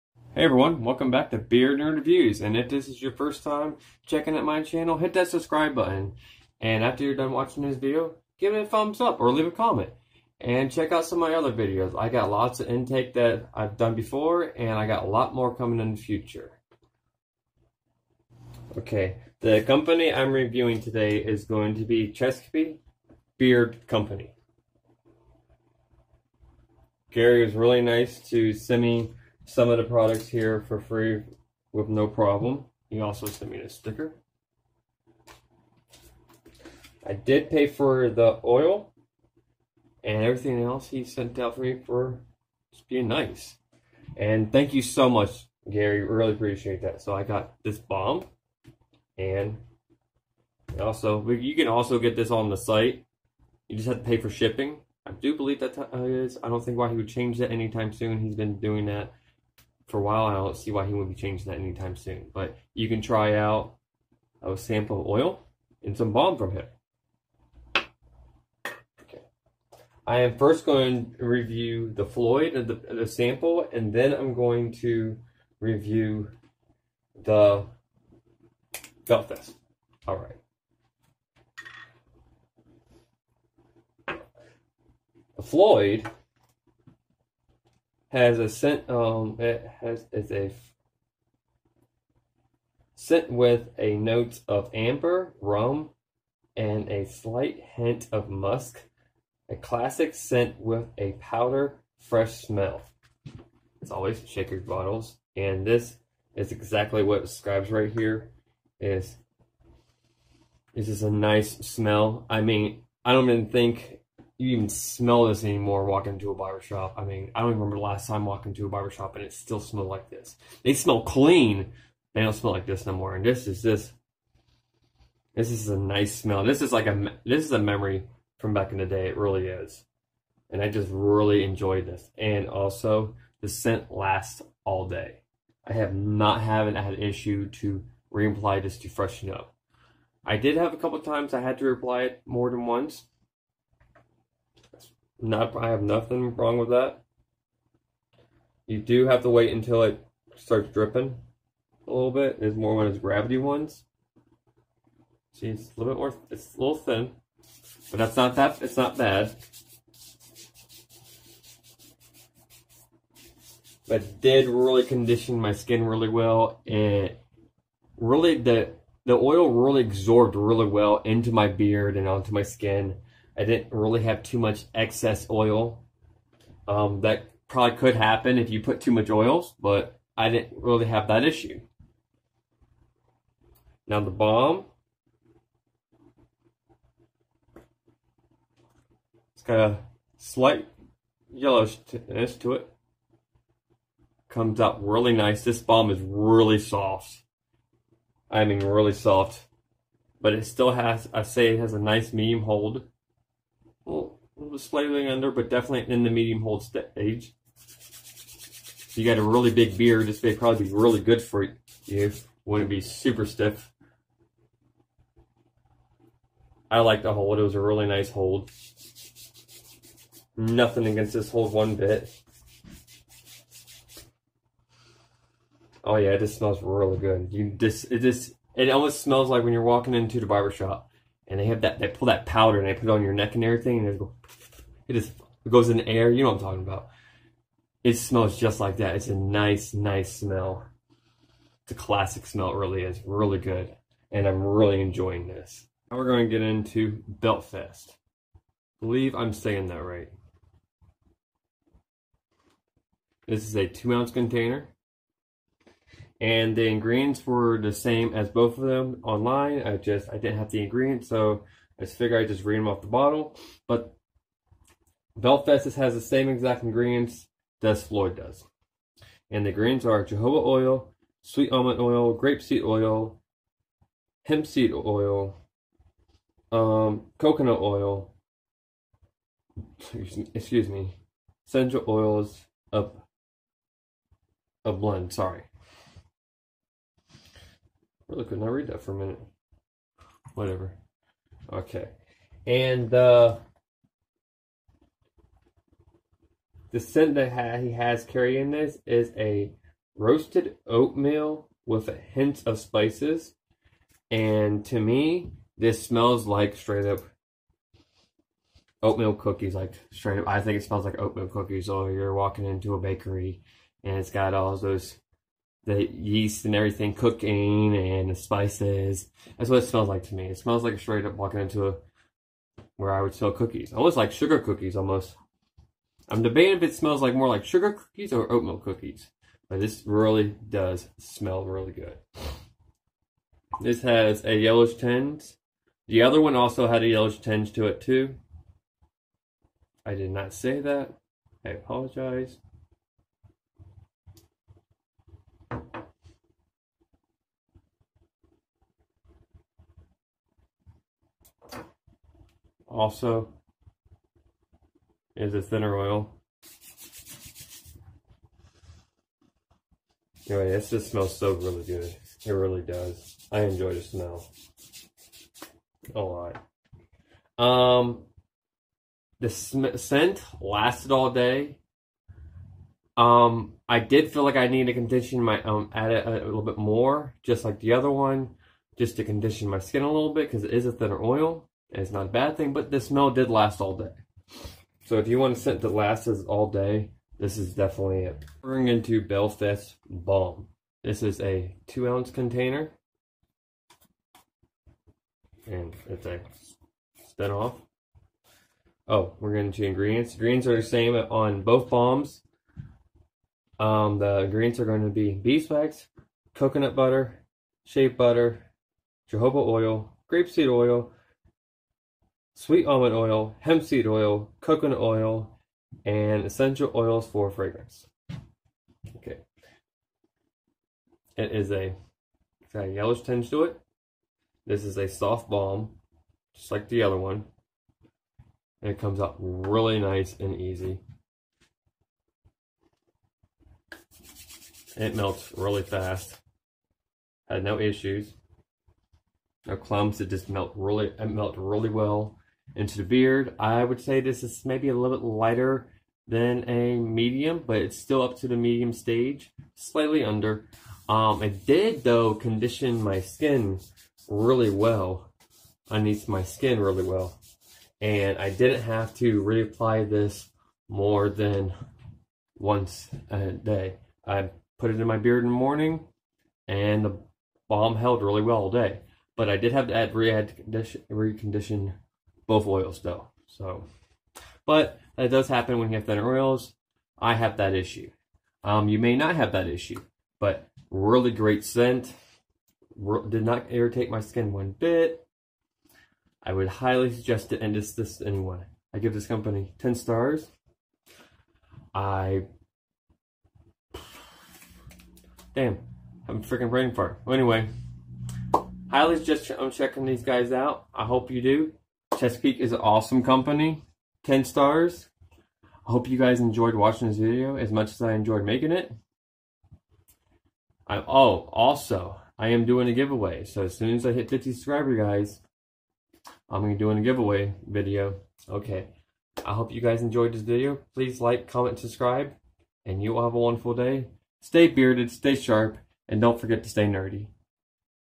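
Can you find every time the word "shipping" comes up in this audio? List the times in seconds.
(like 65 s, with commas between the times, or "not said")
54 s.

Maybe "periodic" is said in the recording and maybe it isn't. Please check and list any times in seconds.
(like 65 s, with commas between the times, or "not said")
not said.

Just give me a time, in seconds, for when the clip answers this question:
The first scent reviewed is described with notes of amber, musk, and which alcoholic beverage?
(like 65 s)
95 s.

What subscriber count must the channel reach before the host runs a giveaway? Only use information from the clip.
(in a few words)
50.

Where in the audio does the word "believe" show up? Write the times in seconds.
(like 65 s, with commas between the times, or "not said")
55 s, 248 s.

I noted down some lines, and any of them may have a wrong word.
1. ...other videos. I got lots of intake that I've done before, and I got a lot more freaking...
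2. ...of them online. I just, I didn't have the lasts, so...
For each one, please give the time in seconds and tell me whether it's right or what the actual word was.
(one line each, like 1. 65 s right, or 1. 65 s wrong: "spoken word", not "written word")
1. 11 s wrong: "coming", not "freaking"
2. 258 s wrong: "ingredients", not "lasts".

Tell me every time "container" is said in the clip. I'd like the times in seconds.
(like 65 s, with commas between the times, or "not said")
254 s, 392 s.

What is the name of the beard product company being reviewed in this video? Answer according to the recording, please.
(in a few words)
Chesapeake Beard Company.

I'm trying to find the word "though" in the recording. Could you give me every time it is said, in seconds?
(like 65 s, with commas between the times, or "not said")
451 s, 472 s.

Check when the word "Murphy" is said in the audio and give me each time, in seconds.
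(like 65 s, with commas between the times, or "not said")
not said.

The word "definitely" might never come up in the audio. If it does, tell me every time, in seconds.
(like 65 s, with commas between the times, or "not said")
205 s, 387 s.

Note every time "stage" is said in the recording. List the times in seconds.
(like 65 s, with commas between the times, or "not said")
206 s, 448 s.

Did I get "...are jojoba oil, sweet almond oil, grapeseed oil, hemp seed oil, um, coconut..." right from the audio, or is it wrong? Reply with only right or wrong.
right.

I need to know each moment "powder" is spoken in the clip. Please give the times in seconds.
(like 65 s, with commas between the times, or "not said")
101 s, 232 s.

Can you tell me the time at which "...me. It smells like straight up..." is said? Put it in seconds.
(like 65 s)
320 s.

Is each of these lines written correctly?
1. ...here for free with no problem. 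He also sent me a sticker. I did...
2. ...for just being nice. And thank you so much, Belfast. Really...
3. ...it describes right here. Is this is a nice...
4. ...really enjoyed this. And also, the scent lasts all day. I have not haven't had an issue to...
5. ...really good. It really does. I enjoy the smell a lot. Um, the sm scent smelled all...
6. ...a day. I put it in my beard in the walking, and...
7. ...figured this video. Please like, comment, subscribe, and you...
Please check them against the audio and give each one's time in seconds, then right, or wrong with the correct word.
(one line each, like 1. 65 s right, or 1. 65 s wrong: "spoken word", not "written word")
1. 30 s right
2. 41 s wrong: "Gary", not "Belfast"
3. 107 s right
4. 130 s right
5. 361 s wrong: "lasted", not "smelled"
6. 463 s wrong: "morning", not "walking"
7. 519 s wrong: "enjoyed", not "figured".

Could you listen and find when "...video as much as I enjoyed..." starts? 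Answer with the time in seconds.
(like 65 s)
506 s.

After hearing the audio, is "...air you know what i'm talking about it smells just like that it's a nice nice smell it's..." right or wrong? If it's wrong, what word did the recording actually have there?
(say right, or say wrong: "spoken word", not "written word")
right.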